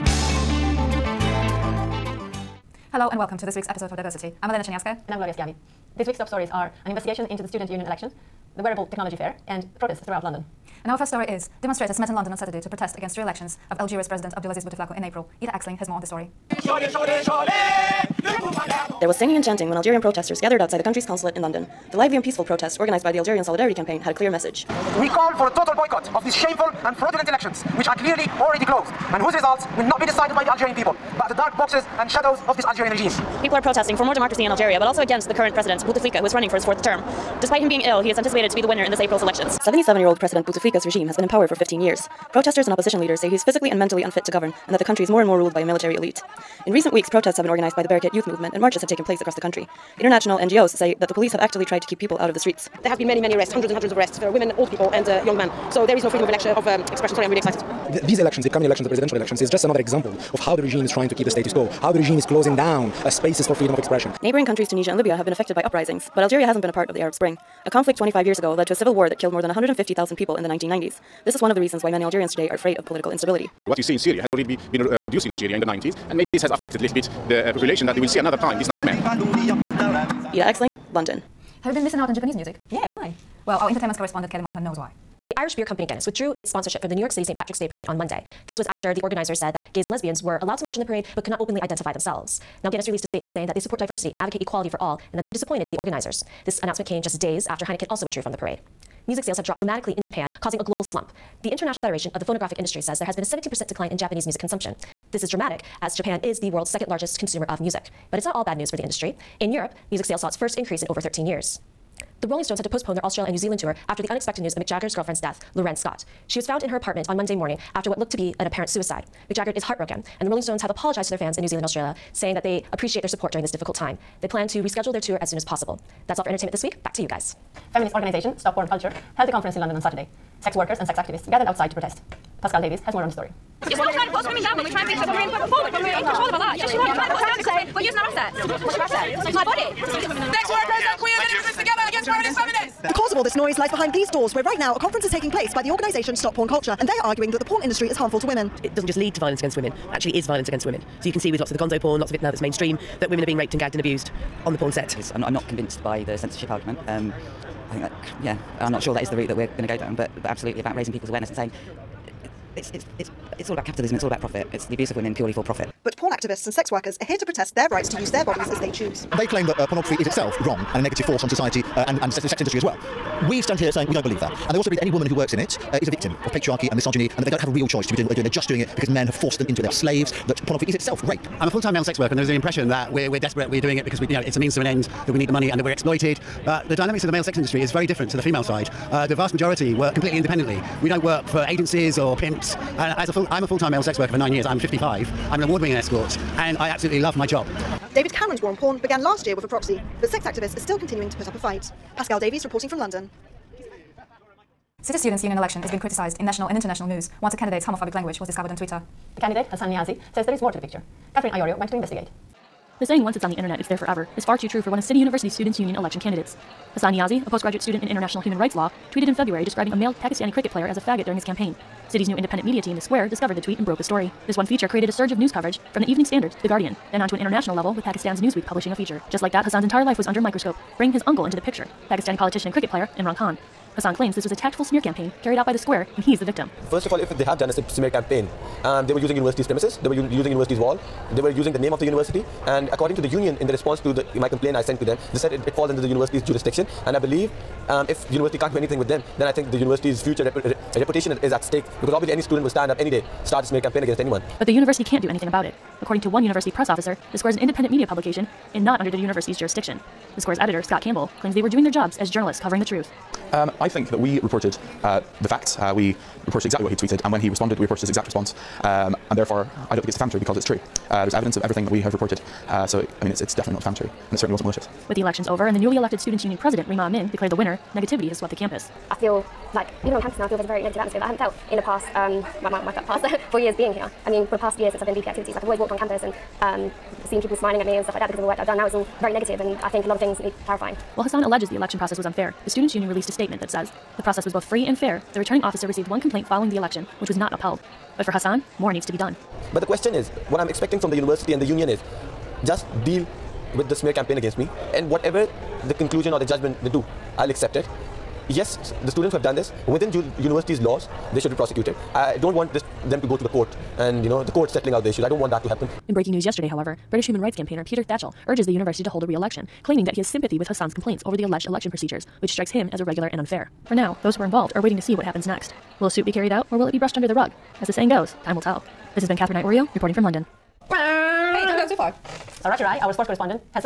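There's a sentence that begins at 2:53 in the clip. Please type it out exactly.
We stand here saying we don't believe that.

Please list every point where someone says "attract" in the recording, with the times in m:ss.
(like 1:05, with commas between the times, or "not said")
not said.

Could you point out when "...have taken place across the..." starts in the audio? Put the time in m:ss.
0:48.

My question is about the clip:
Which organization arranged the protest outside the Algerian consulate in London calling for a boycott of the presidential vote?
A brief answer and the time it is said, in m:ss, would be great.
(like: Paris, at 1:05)
Algerian Solidarity Campaign, at 0:23.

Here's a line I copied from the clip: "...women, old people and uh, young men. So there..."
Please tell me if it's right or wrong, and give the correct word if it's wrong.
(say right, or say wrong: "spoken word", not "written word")
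right.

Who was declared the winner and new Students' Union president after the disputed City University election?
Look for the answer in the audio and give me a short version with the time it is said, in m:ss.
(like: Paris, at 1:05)
Rima Amin, at 4:36.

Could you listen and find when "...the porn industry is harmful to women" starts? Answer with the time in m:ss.
2:27.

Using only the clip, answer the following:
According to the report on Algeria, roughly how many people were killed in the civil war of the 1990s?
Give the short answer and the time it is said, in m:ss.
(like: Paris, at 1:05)
150,000, at 1:09.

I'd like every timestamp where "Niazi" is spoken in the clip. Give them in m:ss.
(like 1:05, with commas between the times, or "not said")
3:29, 3:36.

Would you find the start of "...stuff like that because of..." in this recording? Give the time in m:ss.
4:47.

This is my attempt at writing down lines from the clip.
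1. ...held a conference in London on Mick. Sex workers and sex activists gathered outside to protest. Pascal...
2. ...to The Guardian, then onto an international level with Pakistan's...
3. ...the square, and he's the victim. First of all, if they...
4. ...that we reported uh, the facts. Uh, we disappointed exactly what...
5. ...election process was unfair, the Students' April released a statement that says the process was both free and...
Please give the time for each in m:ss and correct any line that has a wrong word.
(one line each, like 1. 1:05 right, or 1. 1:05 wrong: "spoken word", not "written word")
1. 2:09 wrong: "Saturday", not "Mick"
2. 3:46 right
3. 3:55 right
4. 4:23 wrong: "reported", not "disappointed"
5. 4:51 wrong: "Union", not "April".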